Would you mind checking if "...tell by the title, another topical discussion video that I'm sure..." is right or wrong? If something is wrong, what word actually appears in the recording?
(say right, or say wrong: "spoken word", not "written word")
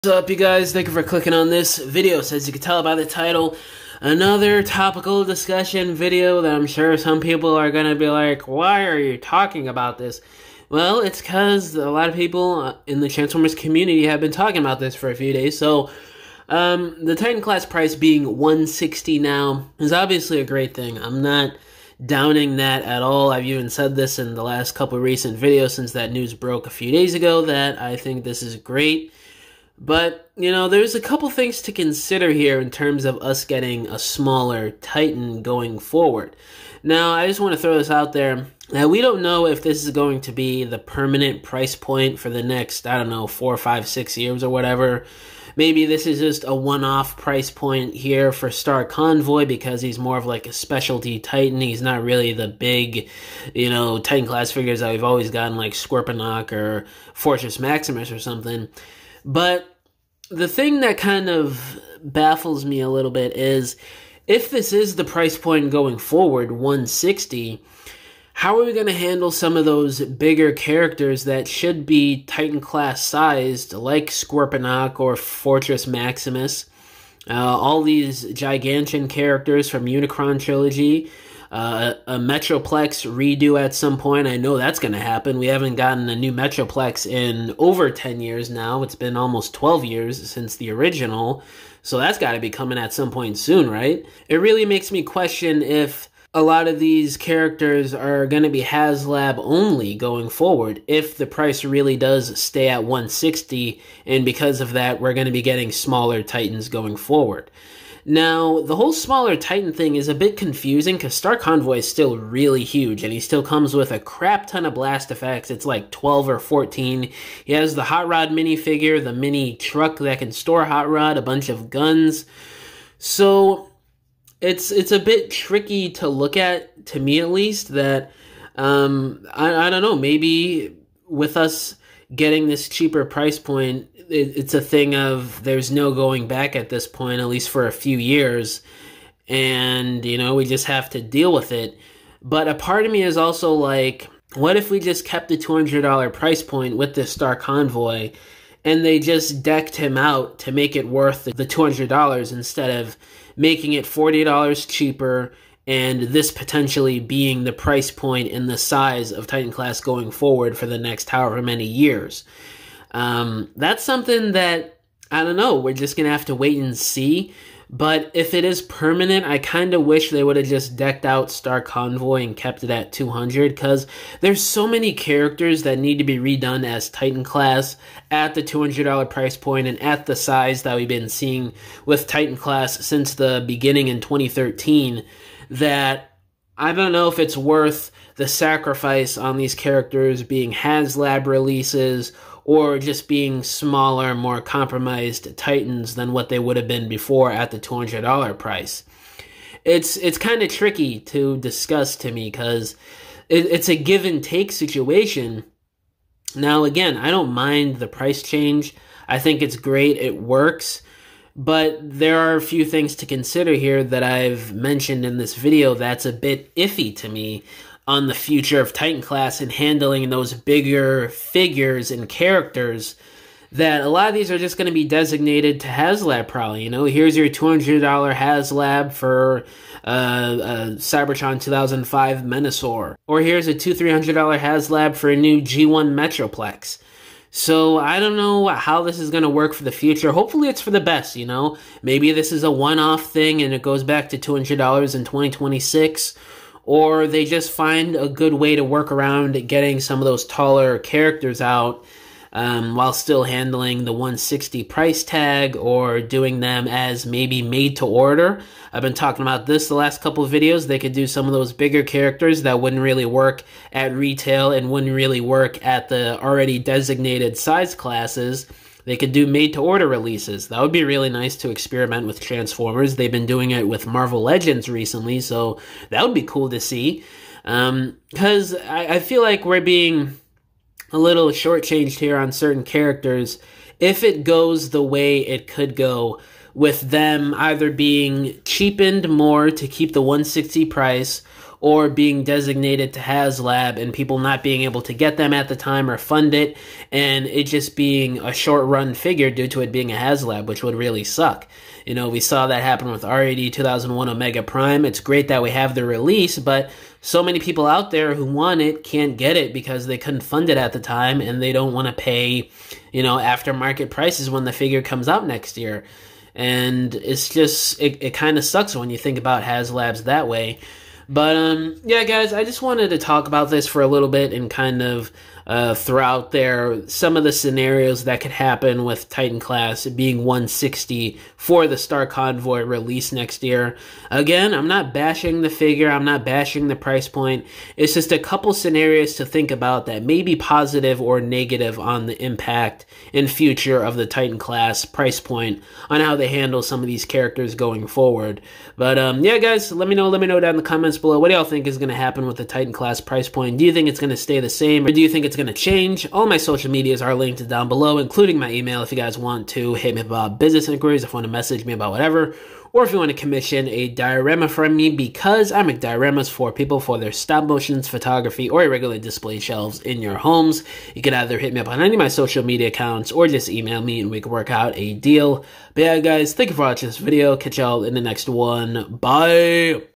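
right.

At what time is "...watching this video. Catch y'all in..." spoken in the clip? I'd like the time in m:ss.
6:16.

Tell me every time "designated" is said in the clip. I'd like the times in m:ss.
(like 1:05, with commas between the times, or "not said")
3:44, 4:26, 4:52.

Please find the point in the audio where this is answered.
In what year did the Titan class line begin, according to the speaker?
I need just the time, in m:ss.
3:04.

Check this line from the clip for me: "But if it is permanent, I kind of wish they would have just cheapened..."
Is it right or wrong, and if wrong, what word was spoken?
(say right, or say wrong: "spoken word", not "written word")
wrong: "decked", not "cheapened".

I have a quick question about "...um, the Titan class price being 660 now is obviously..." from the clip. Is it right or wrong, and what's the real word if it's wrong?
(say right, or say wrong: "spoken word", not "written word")
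wrong: "160", not "660".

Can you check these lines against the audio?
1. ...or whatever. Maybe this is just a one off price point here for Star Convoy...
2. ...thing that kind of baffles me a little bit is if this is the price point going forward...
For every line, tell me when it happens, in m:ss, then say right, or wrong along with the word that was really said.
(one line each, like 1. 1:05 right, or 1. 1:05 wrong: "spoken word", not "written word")
1. 0:44 right
2. 1:00 right.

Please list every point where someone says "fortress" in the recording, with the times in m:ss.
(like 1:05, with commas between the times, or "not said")
0:57, 1:15.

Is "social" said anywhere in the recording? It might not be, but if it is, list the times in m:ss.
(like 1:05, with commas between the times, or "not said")
5:56, 6:12.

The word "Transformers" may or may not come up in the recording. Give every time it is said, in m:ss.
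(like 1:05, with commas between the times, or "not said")
0:13, 4:32.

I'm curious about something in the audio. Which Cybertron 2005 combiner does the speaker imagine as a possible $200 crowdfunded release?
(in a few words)
Menasor.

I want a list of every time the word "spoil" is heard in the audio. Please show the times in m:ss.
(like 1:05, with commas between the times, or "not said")
not said.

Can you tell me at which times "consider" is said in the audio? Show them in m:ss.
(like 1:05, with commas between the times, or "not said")
0:31, 3:33.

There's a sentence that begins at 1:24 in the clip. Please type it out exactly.
I know that's going to happen.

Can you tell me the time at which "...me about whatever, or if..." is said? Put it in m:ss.
6:01.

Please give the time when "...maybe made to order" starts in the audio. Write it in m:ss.
4:17.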